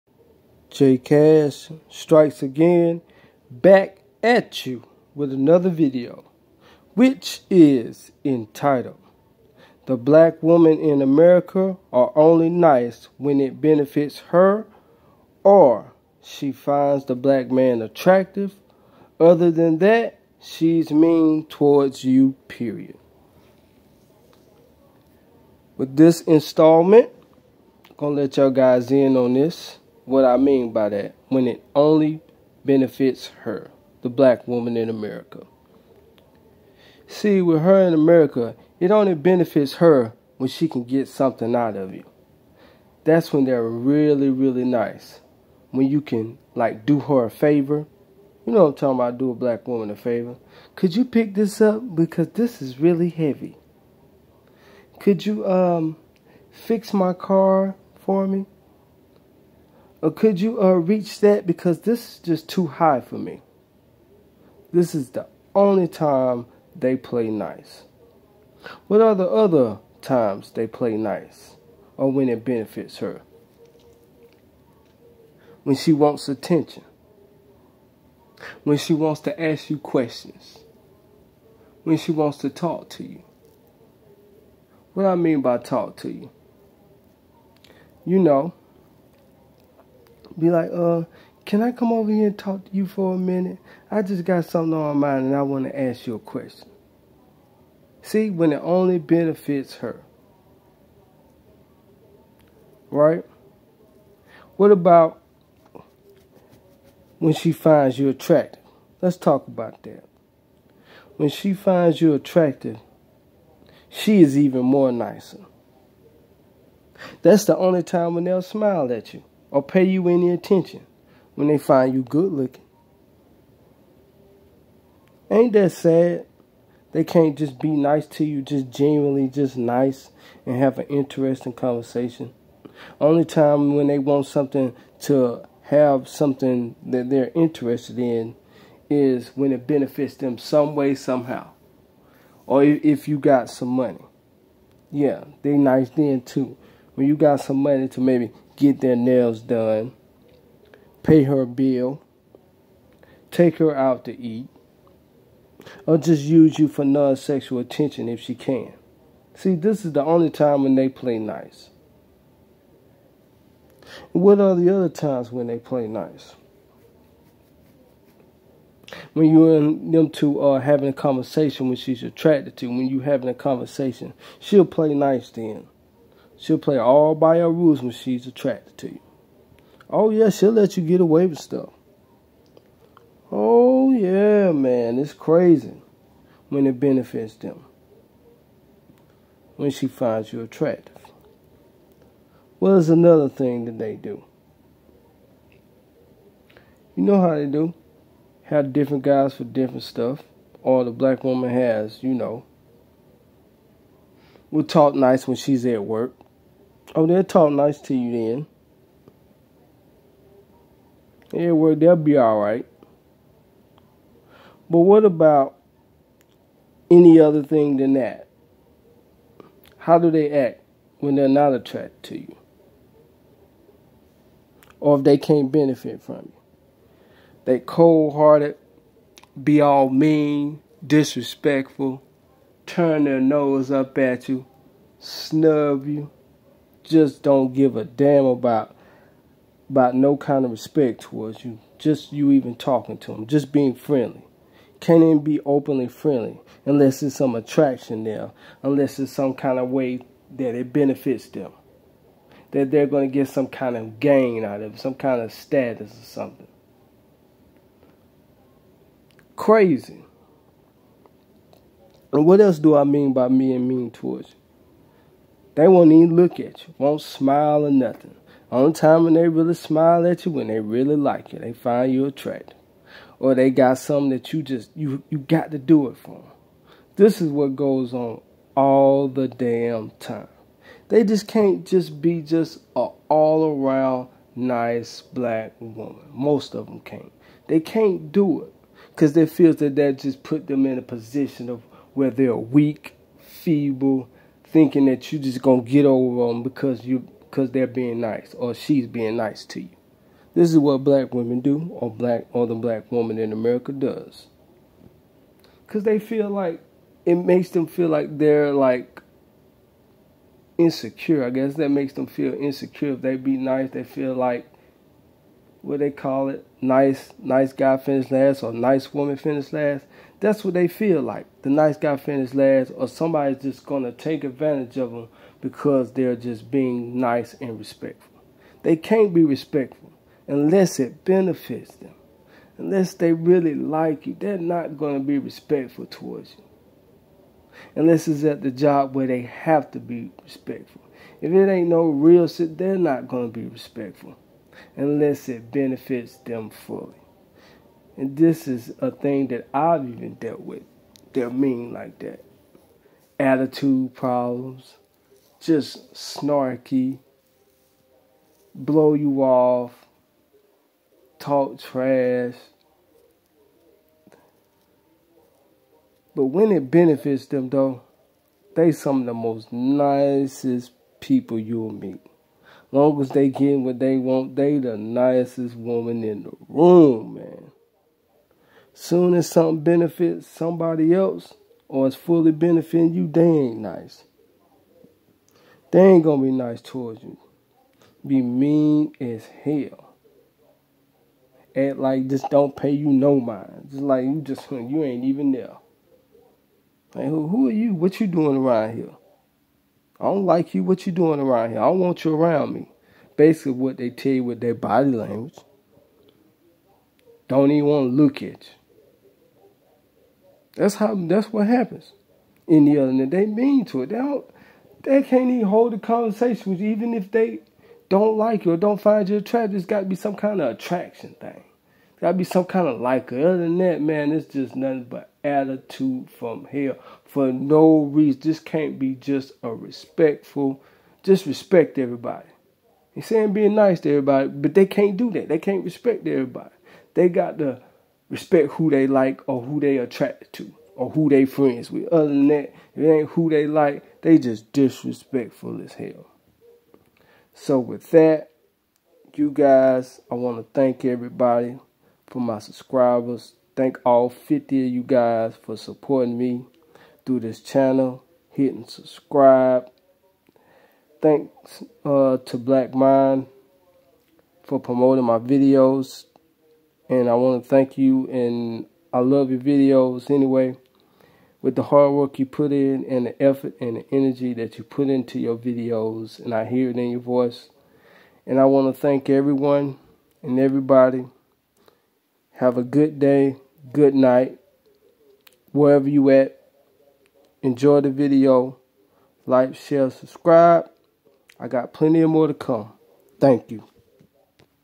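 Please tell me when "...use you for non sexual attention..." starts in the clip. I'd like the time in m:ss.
2:36.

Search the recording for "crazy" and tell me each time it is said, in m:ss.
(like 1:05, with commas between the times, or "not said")
3:05, 4:19.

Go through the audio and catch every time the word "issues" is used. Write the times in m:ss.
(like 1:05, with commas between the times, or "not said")
not said.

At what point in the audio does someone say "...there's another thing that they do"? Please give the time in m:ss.
3:12.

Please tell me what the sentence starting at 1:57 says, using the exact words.
That's the only time when they'll smile at you or pay you any attention when they find you good looking.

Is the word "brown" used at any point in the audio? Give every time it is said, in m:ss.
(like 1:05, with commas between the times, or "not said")
not said.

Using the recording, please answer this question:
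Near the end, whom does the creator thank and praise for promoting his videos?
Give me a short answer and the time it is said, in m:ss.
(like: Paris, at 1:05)
Black Mind, at 7:42.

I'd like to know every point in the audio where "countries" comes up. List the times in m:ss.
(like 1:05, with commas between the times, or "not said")
not said.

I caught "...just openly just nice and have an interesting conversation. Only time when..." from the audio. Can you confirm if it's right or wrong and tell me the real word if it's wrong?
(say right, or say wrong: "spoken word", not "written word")
wrong: "genuinely", not "openly".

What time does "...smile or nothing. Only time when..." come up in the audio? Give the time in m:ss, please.
4:27.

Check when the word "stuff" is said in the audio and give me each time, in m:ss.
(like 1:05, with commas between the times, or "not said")
3:01, 3:19.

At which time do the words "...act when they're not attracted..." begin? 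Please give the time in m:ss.
3:40.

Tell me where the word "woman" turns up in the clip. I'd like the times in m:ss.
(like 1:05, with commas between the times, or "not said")
0:10, 0:34, 0:49, 3:21, 4:45, 5:02, 5:18, 6:15.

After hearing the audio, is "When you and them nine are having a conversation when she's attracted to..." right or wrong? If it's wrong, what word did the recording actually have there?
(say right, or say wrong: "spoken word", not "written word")
wrong: "two", not "nine".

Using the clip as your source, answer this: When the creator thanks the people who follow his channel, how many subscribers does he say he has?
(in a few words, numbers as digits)
50.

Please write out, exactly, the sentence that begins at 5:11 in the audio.
I guess that makes them feel insecure.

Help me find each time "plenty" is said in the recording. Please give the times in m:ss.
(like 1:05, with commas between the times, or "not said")
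8:11.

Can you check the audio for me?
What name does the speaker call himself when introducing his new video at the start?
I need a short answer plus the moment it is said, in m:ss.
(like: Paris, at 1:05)
J Cash, at 0:00.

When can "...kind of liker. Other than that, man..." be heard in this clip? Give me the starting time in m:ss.
7:02.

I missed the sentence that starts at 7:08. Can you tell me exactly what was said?
This can't be just a respectful.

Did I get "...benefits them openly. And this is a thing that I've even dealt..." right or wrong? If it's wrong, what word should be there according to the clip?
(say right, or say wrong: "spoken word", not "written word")
wrong: "fully", not "openly".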